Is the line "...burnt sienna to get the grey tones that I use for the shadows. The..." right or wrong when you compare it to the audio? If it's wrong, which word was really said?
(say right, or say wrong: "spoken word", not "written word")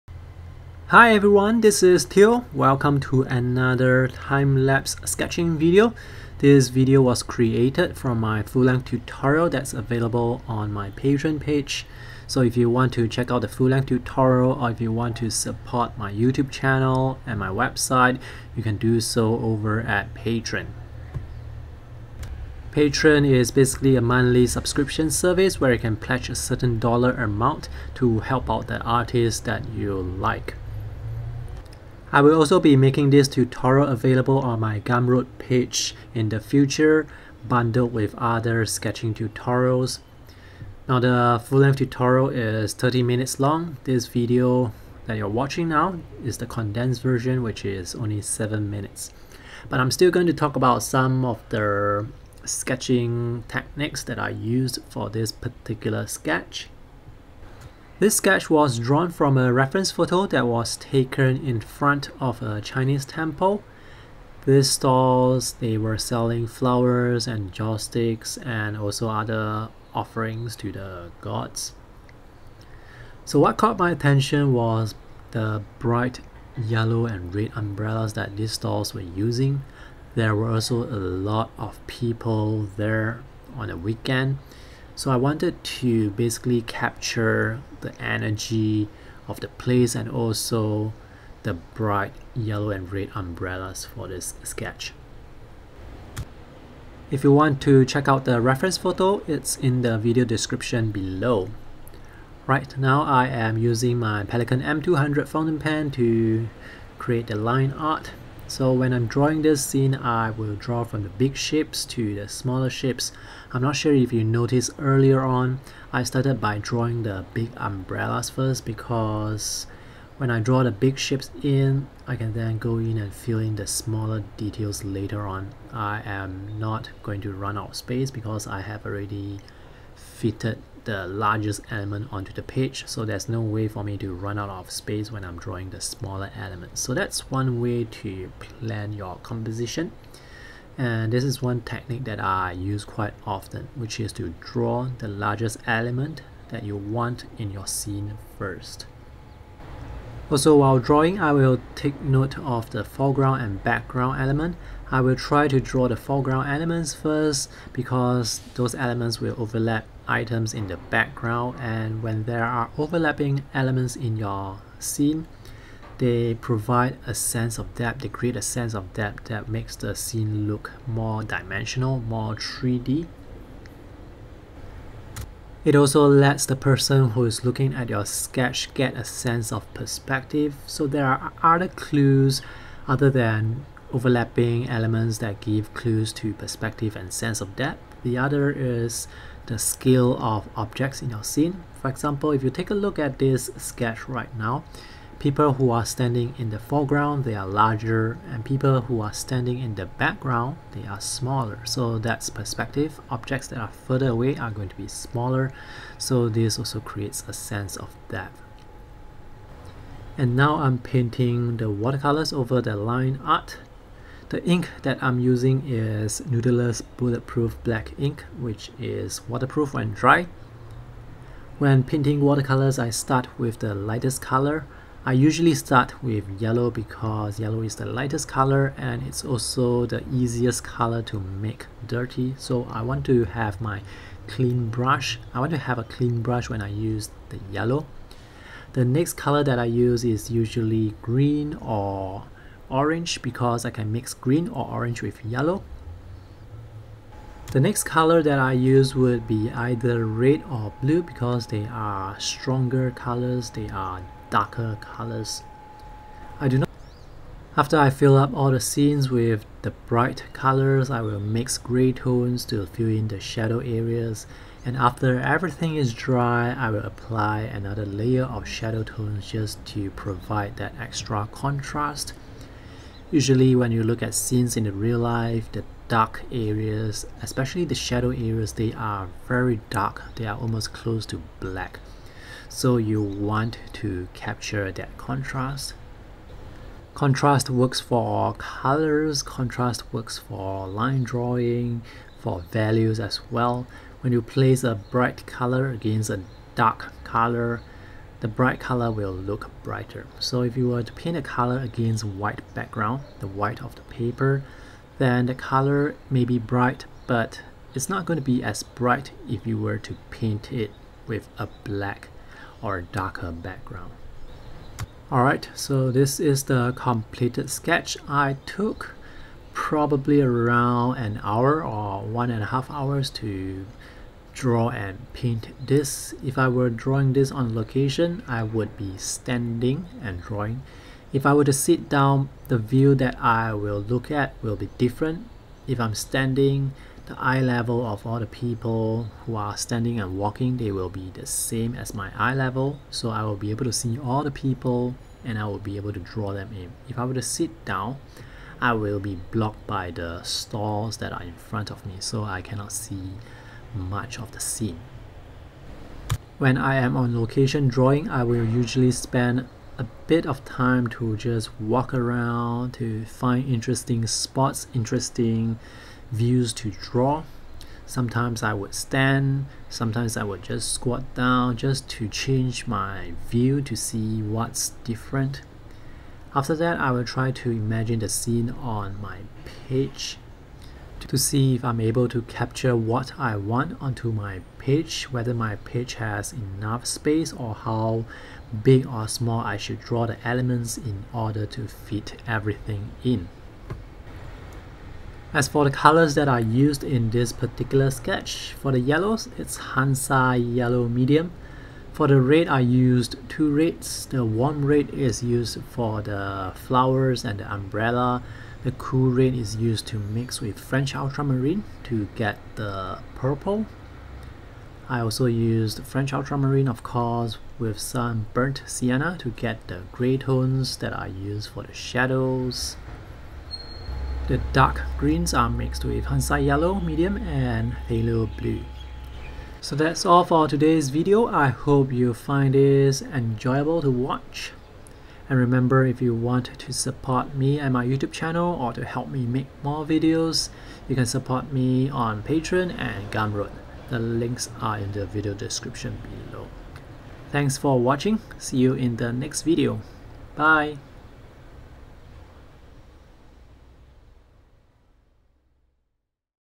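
right.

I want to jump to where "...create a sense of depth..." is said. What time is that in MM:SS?
02:48.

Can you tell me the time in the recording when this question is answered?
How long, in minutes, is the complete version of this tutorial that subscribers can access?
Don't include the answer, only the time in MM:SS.
00:42.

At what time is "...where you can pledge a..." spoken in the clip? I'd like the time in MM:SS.
00:25.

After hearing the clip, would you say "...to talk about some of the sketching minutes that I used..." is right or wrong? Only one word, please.
wrong.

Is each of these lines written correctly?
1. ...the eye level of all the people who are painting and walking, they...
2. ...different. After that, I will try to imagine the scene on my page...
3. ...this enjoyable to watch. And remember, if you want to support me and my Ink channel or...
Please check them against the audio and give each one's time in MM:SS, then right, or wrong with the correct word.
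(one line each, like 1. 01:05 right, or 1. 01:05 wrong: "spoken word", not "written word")
1. 05:37 wrong: "standing", not "painting"
2. 06:14 right
3. 07:12 wrong: "YouTube", not "Ink".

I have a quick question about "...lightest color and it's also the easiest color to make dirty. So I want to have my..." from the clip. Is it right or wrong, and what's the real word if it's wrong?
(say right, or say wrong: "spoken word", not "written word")
right.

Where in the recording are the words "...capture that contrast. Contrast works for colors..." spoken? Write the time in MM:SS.
04:44.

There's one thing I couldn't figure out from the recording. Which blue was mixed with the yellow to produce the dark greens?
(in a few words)
Phthalo blue.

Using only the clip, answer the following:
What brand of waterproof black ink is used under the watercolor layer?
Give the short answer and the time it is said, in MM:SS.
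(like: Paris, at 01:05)
Noodler's Bulletproof Black Ink, at 03:36.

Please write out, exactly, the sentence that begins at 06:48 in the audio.
The cool red is used to mix with French ultramarine to get the purple.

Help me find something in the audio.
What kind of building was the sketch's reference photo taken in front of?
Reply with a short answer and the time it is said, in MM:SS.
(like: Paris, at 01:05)
Chinese temple, at 01:02.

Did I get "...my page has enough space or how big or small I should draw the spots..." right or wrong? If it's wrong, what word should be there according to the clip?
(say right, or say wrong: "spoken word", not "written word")
wrong: "elements", not "spots".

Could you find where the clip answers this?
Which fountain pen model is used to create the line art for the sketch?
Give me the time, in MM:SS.
01:44.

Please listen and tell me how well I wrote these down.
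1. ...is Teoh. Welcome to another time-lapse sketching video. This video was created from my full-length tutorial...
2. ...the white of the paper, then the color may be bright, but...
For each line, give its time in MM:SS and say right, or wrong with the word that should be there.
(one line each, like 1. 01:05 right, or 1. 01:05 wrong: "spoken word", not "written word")
1. 00:01 right
2. 05:03 right.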